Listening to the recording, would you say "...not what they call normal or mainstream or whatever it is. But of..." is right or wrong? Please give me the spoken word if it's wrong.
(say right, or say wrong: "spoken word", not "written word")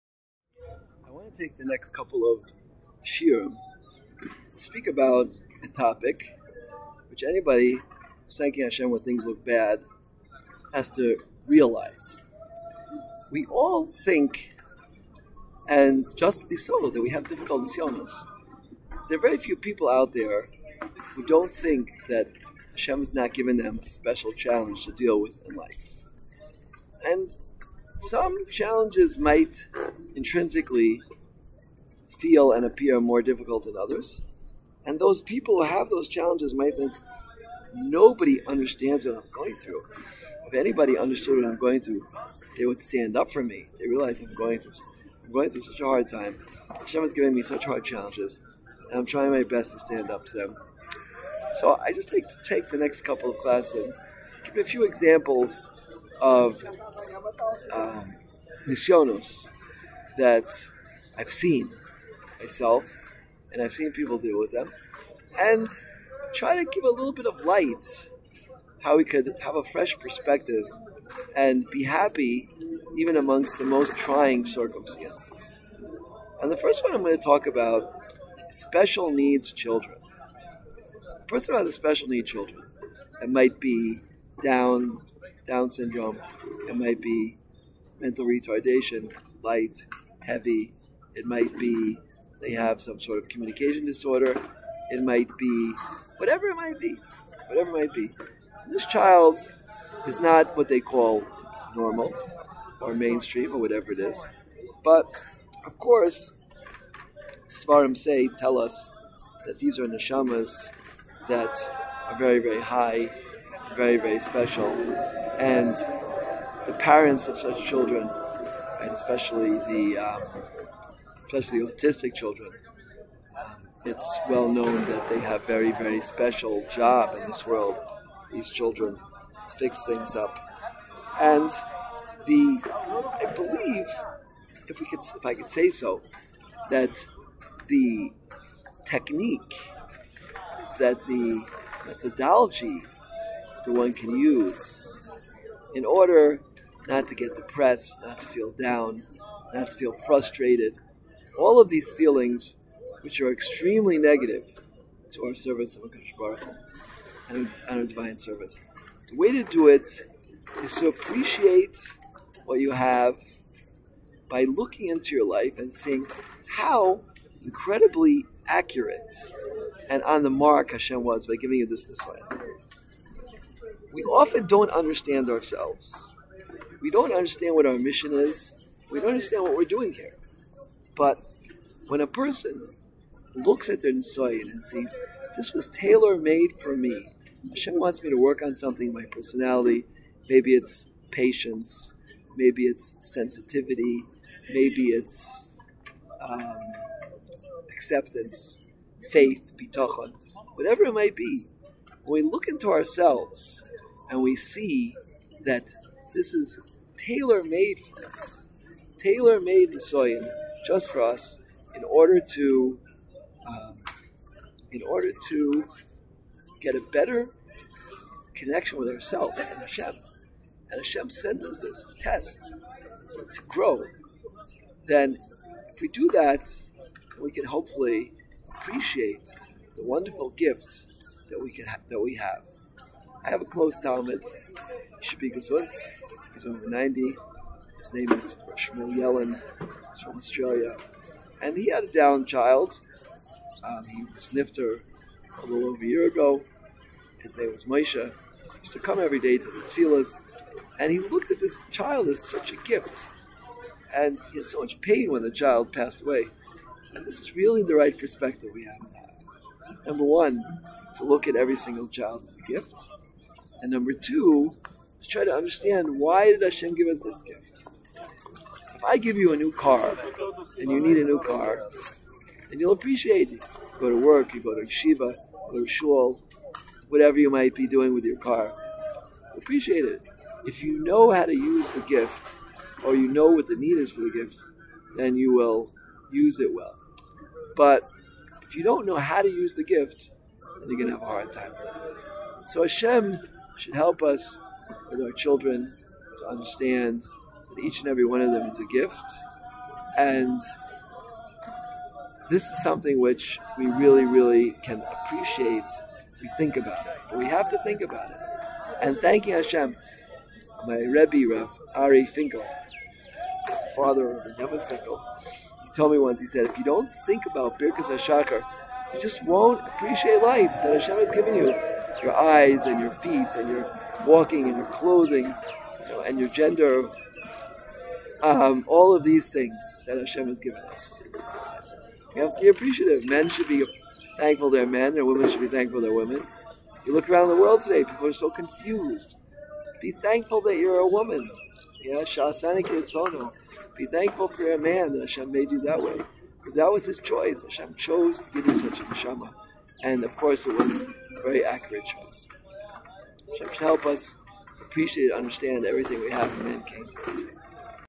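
right.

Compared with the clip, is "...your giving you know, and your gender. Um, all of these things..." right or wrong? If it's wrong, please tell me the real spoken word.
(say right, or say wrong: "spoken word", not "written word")
wrong: "clothing", not "giving".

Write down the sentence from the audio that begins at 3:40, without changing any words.
And Hashem sent us this test to grow.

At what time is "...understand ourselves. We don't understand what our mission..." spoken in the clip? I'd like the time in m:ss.
2:54.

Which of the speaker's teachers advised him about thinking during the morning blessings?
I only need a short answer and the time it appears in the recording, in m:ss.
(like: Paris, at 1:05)
Rav Ari Finkel, at 5:11.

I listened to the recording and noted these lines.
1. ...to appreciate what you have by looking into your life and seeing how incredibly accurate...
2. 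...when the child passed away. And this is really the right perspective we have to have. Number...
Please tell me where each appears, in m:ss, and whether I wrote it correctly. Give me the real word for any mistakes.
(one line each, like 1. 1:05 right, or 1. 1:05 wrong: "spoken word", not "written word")
1. 2:40 right
2. 4:15 right.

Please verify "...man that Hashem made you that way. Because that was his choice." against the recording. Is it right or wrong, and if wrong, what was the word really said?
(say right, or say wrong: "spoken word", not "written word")
right.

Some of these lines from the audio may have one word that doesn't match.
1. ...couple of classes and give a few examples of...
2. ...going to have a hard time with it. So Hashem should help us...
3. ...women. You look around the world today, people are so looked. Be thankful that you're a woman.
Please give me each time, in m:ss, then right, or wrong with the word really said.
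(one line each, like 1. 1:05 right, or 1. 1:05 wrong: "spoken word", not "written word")
1. 0:53 right
2. 4:50 right
3. 5:35 wrong: "confused", not "looked".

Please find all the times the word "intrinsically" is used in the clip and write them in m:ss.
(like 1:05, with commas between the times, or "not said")
0:30.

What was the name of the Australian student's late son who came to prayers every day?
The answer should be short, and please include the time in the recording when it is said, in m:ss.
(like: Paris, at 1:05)
Moshe, at 4:07.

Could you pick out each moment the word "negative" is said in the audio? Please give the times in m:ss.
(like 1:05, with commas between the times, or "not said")
2:33.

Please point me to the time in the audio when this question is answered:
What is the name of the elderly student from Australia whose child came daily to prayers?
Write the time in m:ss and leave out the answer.
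3:58.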